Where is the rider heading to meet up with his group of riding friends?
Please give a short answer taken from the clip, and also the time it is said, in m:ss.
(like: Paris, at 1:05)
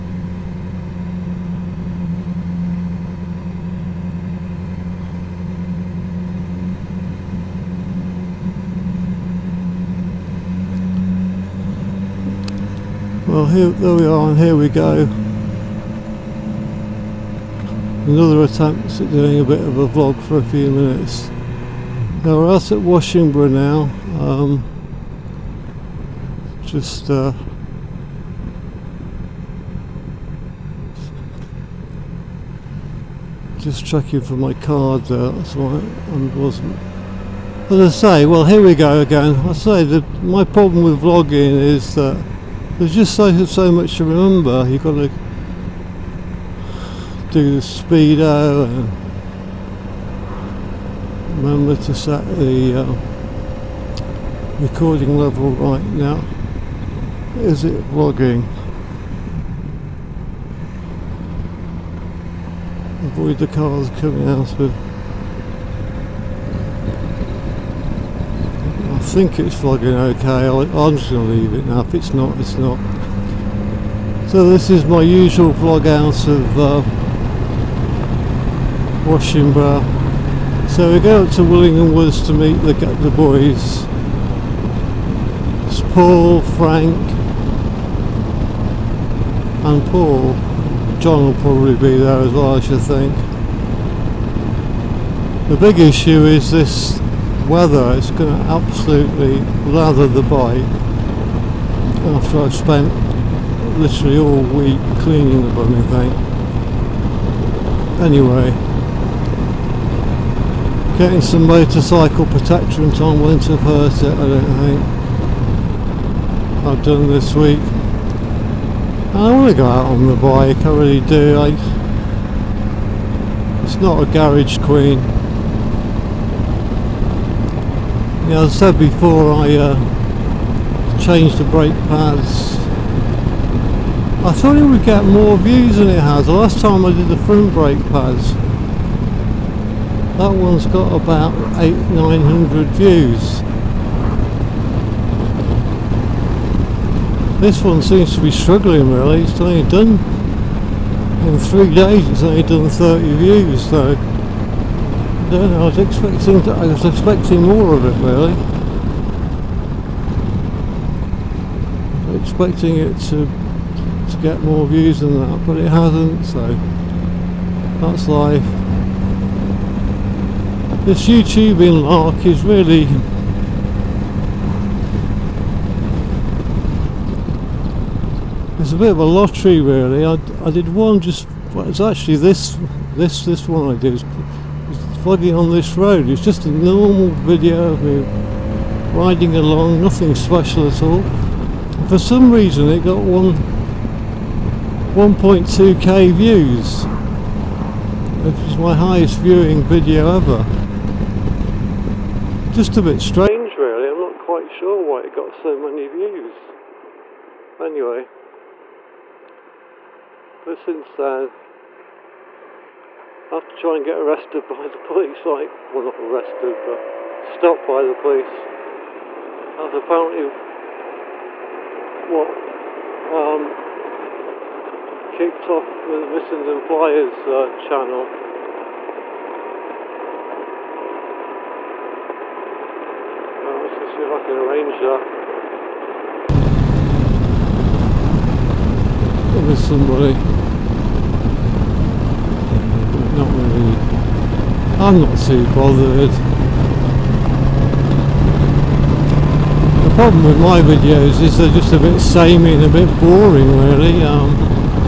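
Willingham Woods, at 1:21.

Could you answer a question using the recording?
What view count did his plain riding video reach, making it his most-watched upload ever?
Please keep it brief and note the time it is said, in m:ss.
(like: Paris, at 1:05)
1.2k, at 3:14.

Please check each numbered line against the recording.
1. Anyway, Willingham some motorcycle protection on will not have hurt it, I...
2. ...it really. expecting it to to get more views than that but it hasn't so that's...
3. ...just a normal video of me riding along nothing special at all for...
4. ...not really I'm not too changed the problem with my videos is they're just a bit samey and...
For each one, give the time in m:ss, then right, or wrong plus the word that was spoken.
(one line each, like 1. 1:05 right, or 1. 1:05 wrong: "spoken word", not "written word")
1. 1:48 wrong: "Getting", not "Willingham"
2. 2:37 right
3. 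3:06 right
4. 4:03 wrong: "bothered", not "changed".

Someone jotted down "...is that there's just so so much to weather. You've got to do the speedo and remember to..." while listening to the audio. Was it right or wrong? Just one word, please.
wrong.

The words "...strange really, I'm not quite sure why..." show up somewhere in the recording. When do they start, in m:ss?
3:22.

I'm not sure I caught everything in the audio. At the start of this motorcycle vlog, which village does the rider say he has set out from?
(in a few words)
Washingborough.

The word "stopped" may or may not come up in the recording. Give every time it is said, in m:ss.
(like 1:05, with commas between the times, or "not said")
3:37.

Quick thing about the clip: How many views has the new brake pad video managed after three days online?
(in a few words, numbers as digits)
30.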